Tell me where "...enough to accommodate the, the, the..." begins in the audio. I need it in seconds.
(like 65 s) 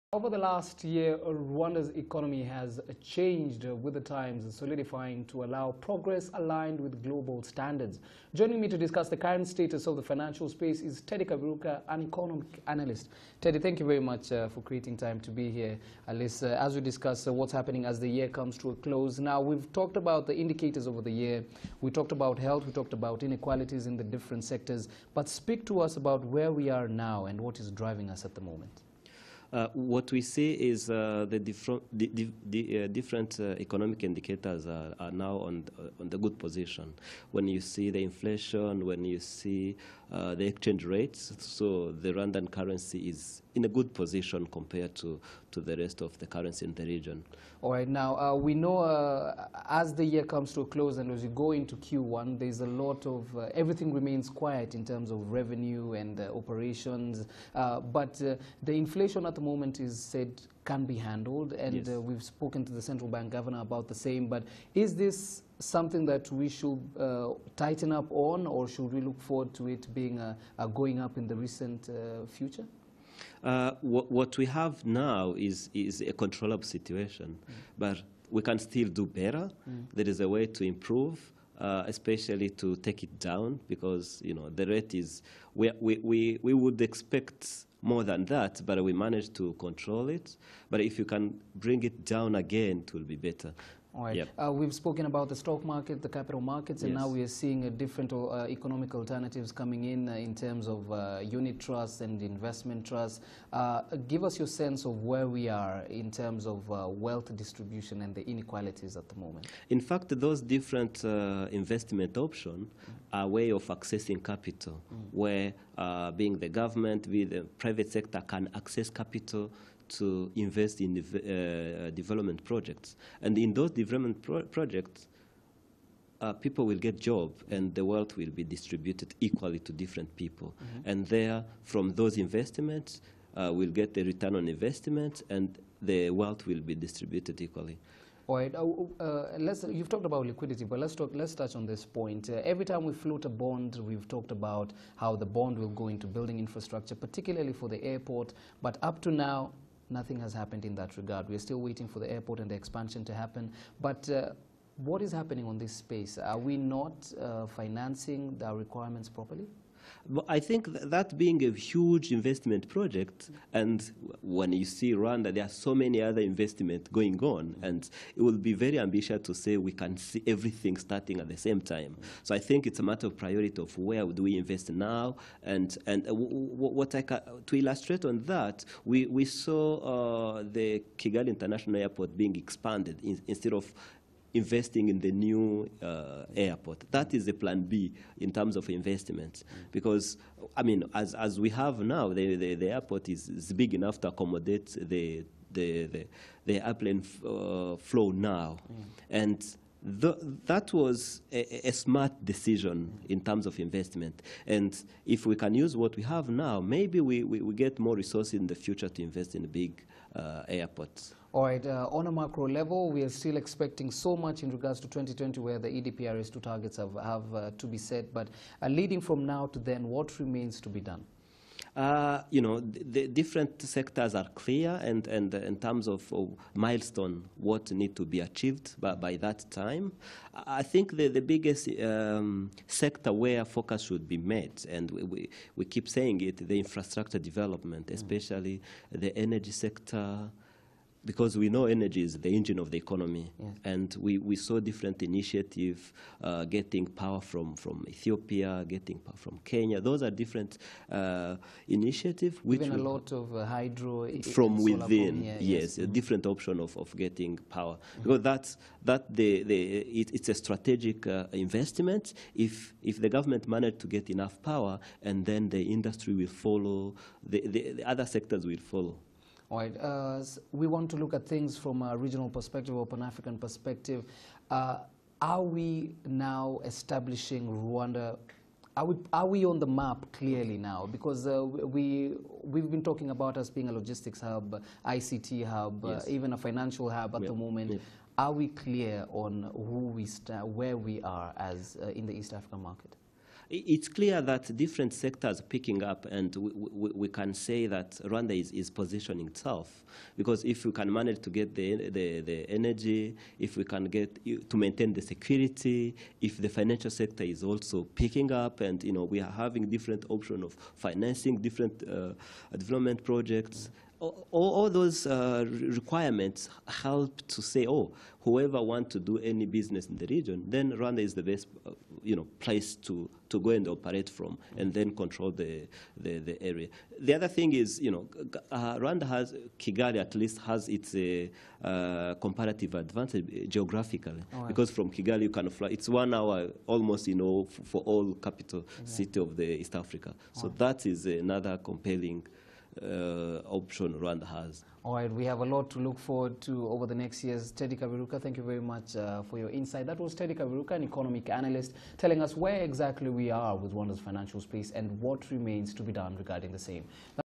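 193 s.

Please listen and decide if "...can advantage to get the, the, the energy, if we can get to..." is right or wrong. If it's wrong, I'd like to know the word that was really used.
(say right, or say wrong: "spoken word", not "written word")
wrong: "manage", not "advantage".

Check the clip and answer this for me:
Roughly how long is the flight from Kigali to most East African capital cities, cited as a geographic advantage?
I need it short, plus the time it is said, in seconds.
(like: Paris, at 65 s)
1 hour, at 335 s.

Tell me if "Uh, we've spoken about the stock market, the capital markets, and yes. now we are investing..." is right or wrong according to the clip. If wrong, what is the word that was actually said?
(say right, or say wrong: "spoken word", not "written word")
wrong: "seeing", not "investing".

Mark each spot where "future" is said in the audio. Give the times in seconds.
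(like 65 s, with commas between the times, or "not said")
72 s, 208 s.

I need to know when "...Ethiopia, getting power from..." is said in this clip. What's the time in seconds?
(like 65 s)
247 s.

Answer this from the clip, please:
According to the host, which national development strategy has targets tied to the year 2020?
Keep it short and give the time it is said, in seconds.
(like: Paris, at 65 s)
EDPRS 2, at 215 s.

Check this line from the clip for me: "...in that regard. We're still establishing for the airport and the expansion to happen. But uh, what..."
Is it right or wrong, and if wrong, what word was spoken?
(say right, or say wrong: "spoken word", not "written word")
wrong: "waiting", not "establishing".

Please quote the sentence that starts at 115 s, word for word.
where being the government, with the private sector can access capital to invest in uh, development projects.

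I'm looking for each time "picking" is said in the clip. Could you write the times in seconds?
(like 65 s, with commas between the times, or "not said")
295 s, 307 s.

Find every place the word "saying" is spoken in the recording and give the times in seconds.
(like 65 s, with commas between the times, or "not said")
235 s.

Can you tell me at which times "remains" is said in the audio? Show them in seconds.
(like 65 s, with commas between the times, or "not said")
53 s, 220 s, 355 s.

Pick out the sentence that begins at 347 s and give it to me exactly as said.
Teddy Kaberuka, thank you very much uh, for your insight.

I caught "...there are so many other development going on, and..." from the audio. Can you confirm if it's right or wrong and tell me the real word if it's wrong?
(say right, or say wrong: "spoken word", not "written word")
wrong: "investment", not "development".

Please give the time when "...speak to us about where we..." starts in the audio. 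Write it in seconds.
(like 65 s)
25 s.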